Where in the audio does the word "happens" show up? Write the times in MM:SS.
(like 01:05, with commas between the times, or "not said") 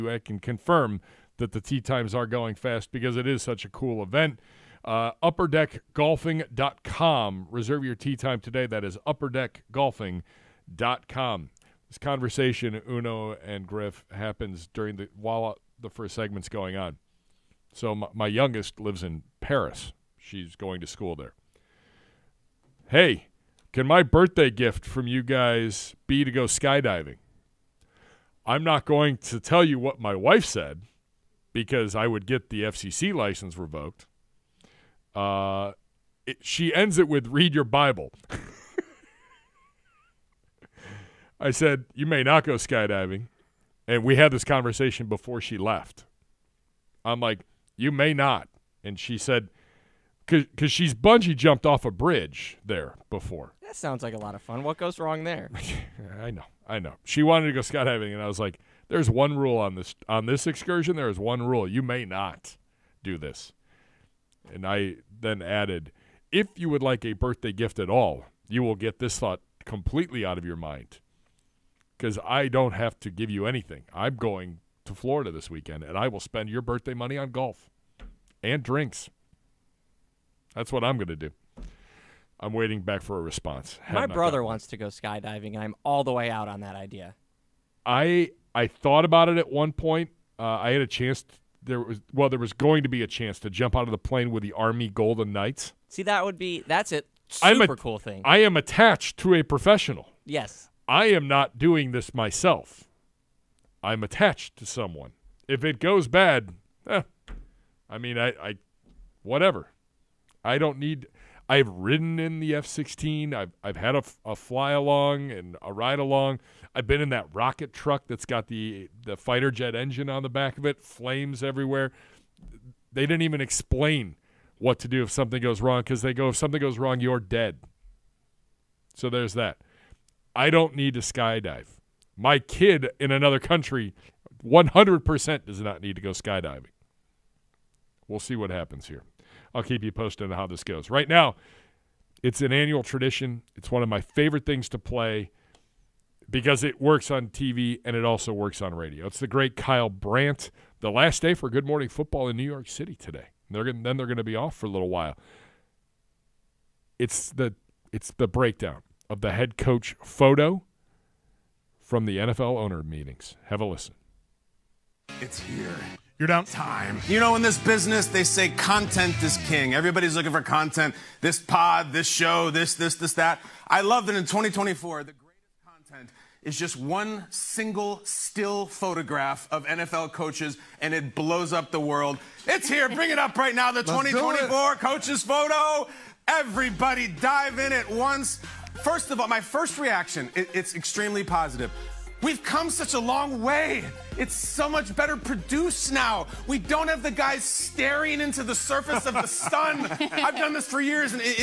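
00:14, 02:18.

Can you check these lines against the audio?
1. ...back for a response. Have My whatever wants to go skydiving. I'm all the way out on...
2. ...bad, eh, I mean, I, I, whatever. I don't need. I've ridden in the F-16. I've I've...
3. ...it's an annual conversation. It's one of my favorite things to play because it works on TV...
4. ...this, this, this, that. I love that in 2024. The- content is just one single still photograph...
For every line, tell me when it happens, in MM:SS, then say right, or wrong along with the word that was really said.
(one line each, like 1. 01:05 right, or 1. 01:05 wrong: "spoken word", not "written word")
1. 01:22 wrong: "brother", not "whatever"
2. 01:46 right
3. 02:22 wrong: "tradition", not "conversation"
4. 02:52 right.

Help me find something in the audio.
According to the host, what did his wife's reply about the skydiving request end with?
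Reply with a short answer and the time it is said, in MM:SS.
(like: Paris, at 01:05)
Read your Bible, at 00:37.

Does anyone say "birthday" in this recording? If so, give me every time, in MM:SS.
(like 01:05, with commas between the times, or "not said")
00:24, 01:07, 01:16.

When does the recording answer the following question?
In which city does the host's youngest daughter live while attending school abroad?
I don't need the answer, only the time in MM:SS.
00:19.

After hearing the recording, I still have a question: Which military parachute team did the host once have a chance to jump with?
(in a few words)
Army Golden Knights.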